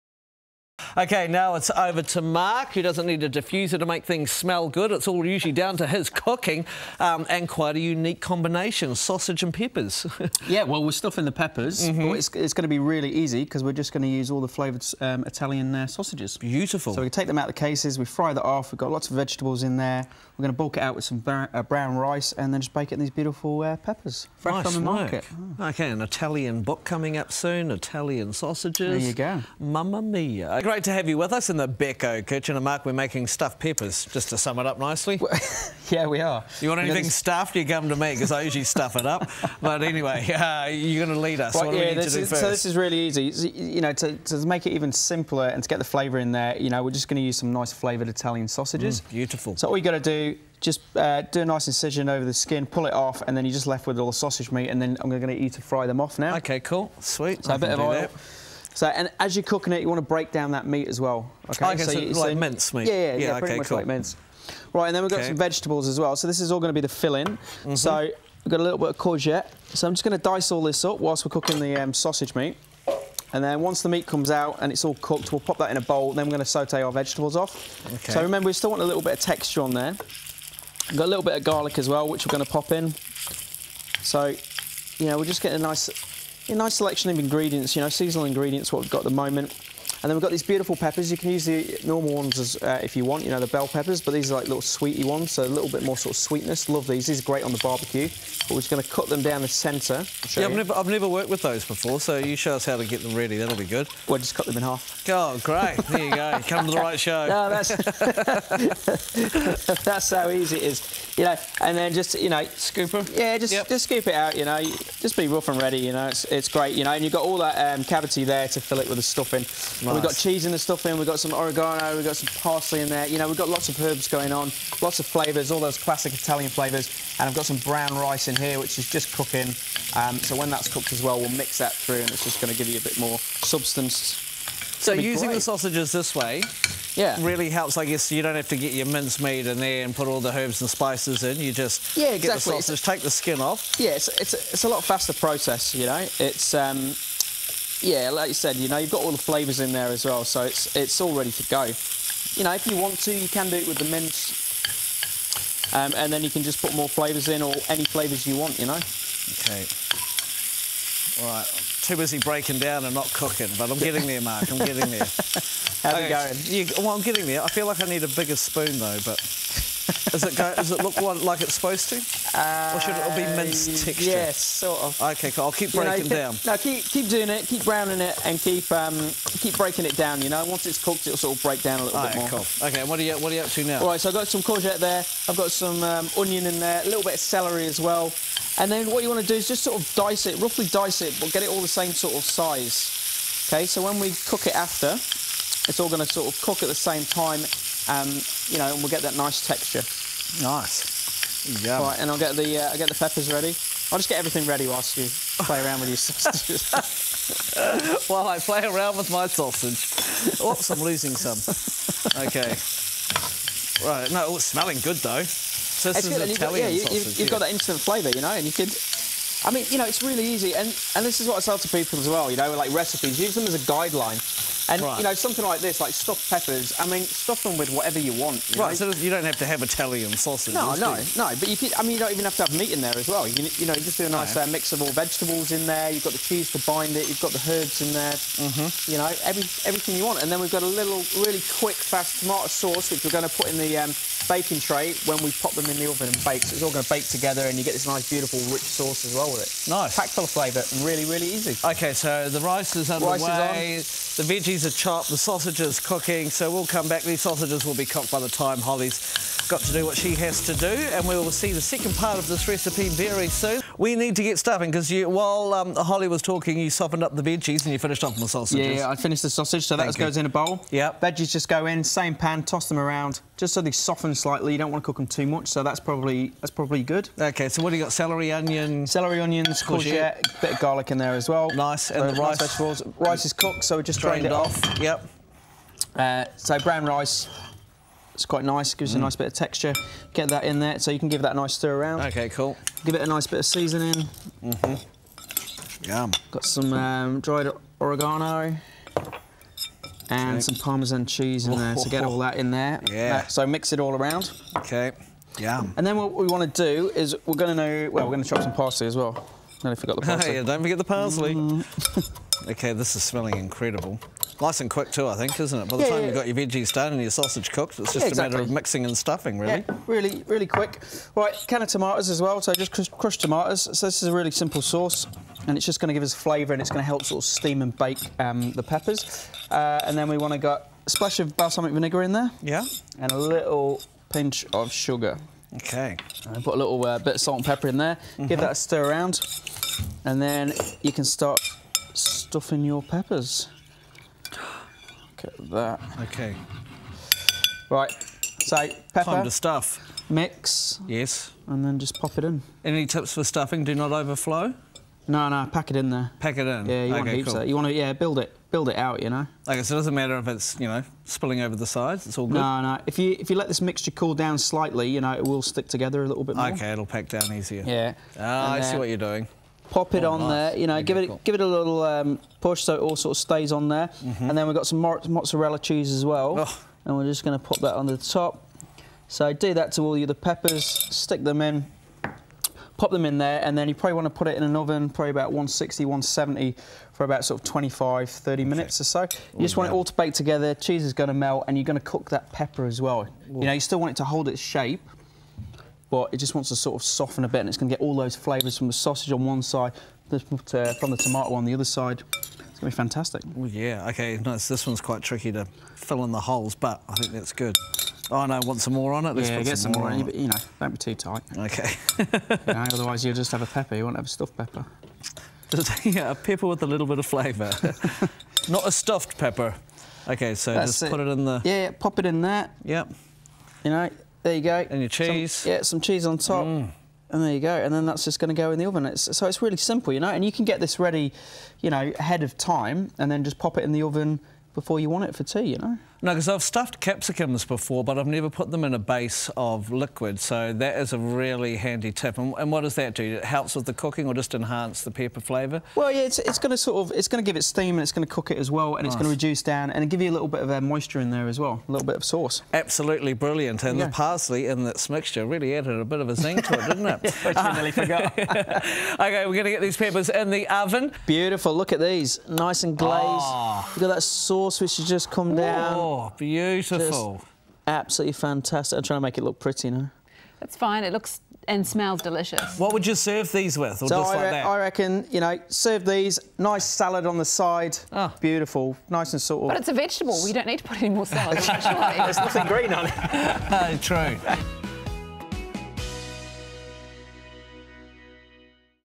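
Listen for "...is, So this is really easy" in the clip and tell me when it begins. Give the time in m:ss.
0:42.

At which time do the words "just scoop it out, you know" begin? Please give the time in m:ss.
1:53.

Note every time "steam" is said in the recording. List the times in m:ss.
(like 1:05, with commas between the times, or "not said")
5:27, 7:27.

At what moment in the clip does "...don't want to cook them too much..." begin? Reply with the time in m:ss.
4:34.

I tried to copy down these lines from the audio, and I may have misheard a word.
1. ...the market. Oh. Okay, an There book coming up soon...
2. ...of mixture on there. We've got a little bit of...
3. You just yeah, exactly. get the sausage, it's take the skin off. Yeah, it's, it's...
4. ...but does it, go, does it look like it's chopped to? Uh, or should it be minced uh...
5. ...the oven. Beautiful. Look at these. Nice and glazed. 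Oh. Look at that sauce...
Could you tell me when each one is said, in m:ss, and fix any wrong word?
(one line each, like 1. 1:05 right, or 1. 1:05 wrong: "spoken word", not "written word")
1. 0:24 wrong: "Italian", not "There"
2. 1:19 wrong: "texture", not "mixture"
3. 2:21 right
4. 2:49 wrong: "supposed", not "chopped"
5. 7:40 right.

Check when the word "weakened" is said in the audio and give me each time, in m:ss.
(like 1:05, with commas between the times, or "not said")
not said.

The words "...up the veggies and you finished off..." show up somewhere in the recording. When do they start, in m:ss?
4:27.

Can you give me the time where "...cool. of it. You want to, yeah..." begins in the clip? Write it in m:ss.
5:57.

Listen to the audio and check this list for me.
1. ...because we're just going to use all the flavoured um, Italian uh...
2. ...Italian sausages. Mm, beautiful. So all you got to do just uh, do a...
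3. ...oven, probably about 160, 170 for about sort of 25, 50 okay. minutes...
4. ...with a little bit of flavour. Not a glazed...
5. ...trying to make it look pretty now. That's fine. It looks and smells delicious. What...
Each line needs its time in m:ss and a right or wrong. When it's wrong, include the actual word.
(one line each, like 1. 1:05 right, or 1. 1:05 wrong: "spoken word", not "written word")
1. 0:13 right
2. 0:48 right
3. 6:24 wrong: "30", not "50"
4. 6:56 wrong: "stuffed", not "glazed"
5. 7:48 right.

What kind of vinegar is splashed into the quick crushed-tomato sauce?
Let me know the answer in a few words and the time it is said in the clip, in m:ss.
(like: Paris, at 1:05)
balsamic vinegar, at 5:31.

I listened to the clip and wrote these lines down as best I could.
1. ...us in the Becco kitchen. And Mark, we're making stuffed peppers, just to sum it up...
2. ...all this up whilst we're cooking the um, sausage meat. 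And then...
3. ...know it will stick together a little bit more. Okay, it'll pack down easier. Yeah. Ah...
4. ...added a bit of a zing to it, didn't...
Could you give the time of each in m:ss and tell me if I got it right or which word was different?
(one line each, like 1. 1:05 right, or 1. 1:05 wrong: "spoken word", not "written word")
1. 0:31 right
2. 1:10 right
3. 6:05 right
4. 7:35 right.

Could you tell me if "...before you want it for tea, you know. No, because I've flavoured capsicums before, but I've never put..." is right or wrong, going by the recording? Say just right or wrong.
wrong.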